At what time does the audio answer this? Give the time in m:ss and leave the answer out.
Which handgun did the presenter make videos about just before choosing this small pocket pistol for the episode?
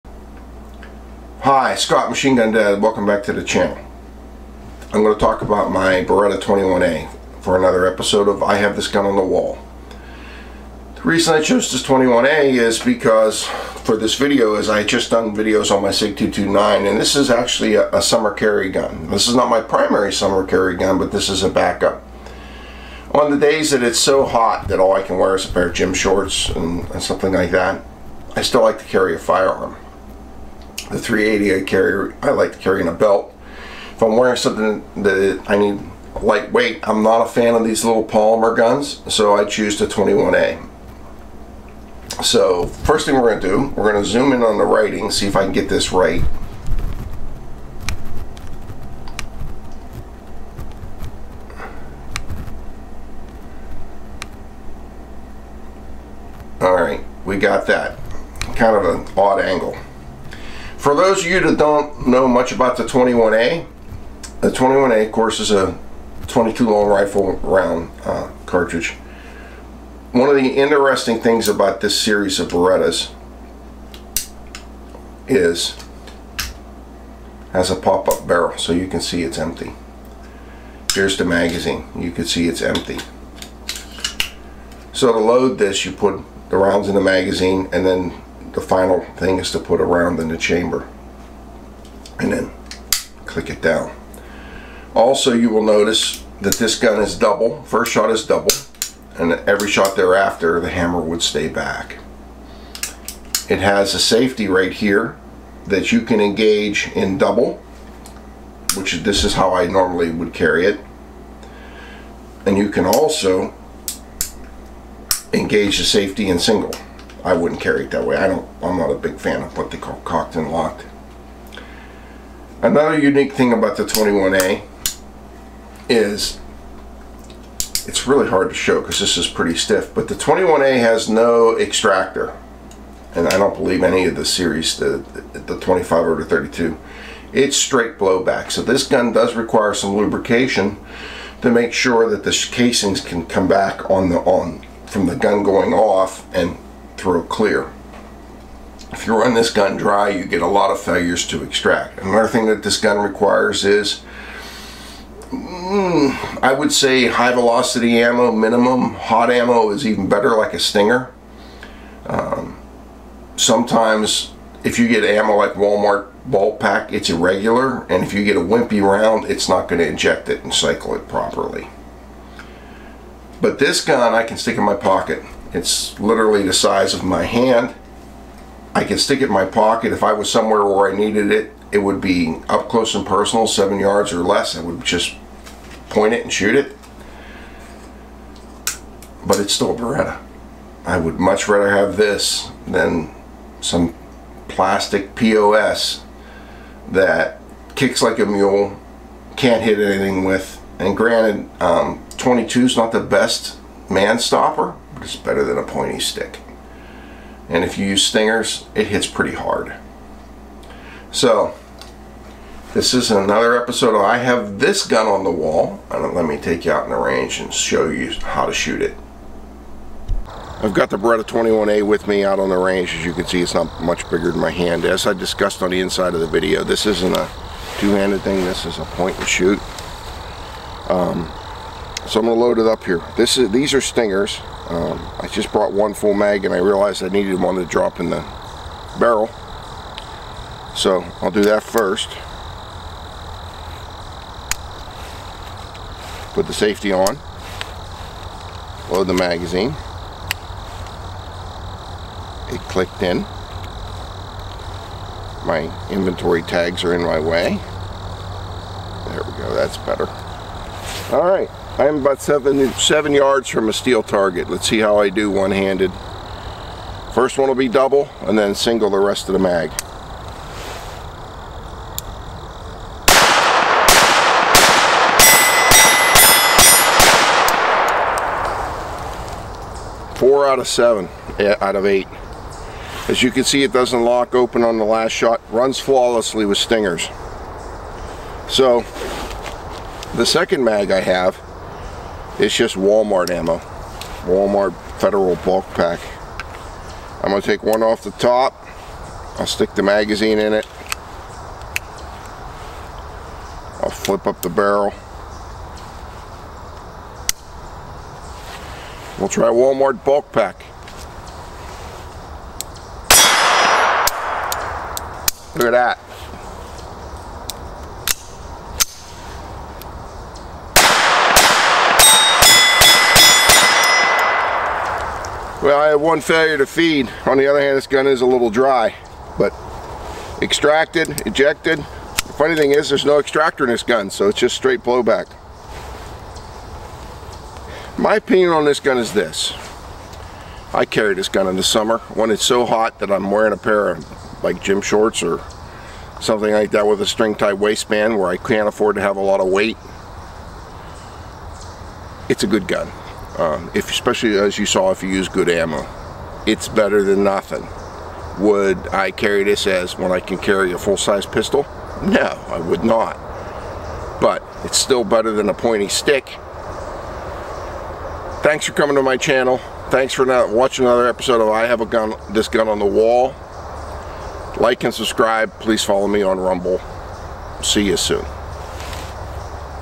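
0:15.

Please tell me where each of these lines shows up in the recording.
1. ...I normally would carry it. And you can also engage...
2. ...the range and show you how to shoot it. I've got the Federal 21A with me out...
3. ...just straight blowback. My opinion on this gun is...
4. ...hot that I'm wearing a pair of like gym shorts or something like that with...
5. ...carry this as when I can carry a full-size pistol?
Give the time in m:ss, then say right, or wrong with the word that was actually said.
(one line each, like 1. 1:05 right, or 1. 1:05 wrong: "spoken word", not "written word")
1. 1:49 right
2. 3:36 wrong: "Beretta", not "Federal"
3. 5:34 right
4. 5:42 right
5. 5:59 right.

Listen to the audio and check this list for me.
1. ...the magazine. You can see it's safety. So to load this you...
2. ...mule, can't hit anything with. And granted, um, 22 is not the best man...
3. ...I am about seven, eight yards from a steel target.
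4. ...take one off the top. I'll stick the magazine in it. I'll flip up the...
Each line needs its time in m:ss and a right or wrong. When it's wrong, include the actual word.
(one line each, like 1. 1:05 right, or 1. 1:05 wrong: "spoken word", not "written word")
1. 1:21 wrong: "empty", not "safety"
2. 3:18 right
3. 4:21 wrong: "seven", not "eight"
4. 4:57 right.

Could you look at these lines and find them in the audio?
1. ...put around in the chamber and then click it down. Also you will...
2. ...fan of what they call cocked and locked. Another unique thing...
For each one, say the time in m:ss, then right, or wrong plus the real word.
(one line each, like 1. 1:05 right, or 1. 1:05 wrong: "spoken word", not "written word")
1. 1:29 right
2. 1:59 right.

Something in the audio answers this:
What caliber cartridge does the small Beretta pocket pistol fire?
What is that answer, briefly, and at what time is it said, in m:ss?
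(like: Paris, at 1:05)
22 long rifle, at 1:06.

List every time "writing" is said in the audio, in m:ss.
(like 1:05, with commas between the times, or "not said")
0:44.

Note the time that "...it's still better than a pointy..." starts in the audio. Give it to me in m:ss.
6:04.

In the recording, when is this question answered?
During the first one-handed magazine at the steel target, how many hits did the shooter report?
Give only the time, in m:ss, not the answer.
4:40.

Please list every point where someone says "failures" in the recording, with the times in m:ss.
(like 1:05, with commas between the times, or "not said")
2:30, 5:26.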